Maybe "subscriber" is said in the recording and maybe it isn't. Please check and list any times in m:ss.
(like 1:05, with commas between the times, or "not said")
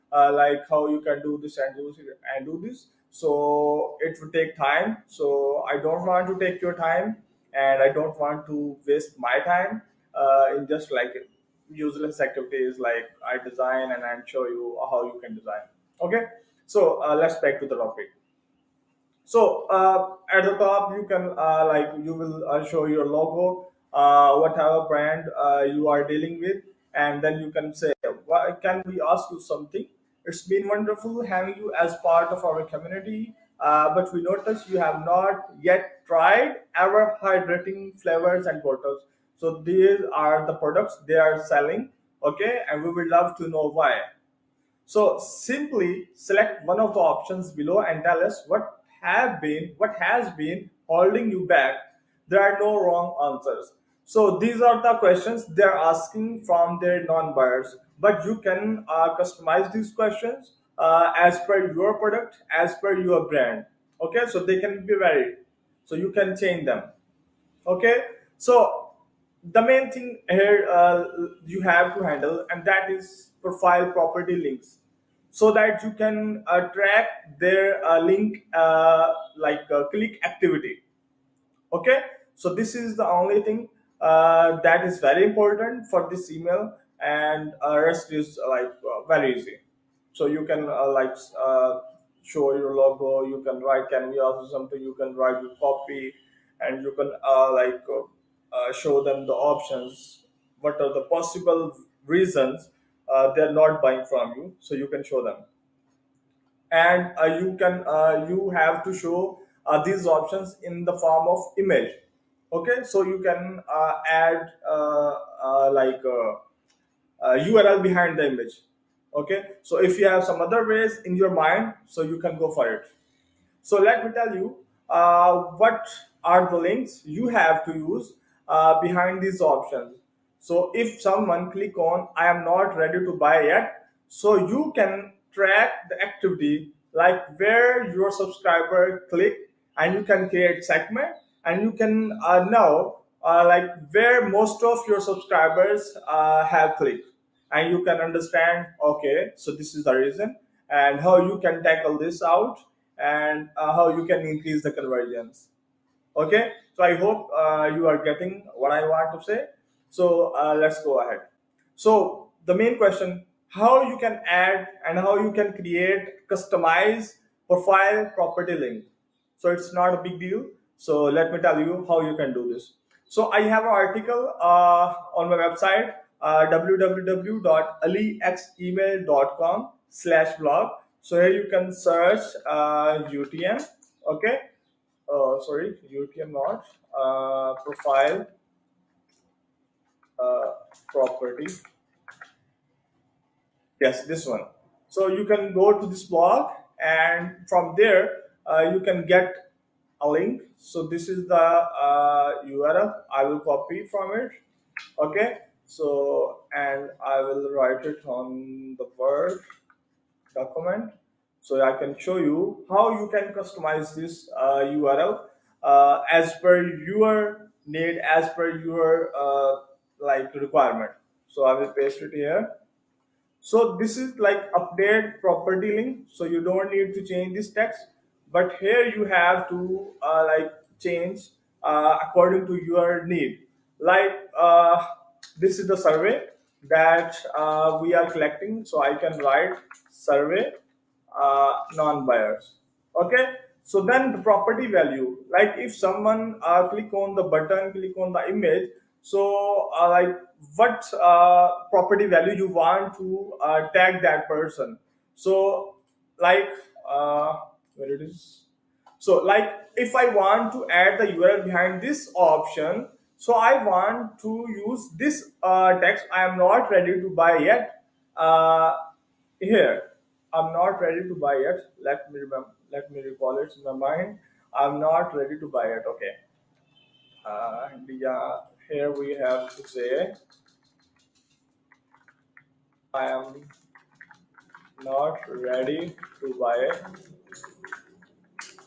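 2:18, 2:24.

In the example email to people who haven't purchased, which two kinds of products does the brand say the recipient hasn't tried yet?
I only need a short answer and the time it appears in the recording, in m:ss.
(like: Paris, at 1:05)
hydrating flavors and bottles, at 0:37.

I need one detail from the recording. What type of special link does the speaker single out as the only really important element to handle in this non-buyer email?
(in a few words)
profile property links.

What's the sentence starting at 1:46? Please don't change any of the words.
And uh, you can uh, you have to show these options in the form of image.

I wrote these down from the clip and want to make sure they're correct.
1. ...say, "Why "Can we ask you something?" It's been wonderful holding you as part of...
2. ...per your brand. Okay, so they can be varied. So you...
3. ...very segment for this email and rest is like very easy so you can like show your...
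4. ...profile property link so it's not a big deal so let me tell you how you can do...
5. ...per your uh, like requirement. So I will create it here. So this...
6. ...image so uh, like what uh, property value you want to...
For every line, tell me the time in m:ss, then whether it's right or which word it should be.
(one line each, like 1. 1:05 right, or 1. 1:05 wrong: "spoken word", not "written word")
1. 0:27 wrong: "having", not "holding"
2. 1:02 right
3. 1:24 wrong: "important", not "segment"
4. 2:47 right
5. 3:38 wrong: "paste", not "create"
6. 4:08 right.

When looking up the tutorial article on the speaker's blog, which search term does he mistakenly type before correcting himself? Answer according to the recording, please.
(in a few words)
utm.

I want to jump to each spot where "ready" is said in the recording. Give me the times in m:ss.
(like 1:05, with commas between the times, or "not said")
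2:12, 4:26, 4:30, 4:35, 4:45.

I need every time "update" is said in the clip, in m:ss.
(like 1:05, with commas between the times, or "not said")
3:44.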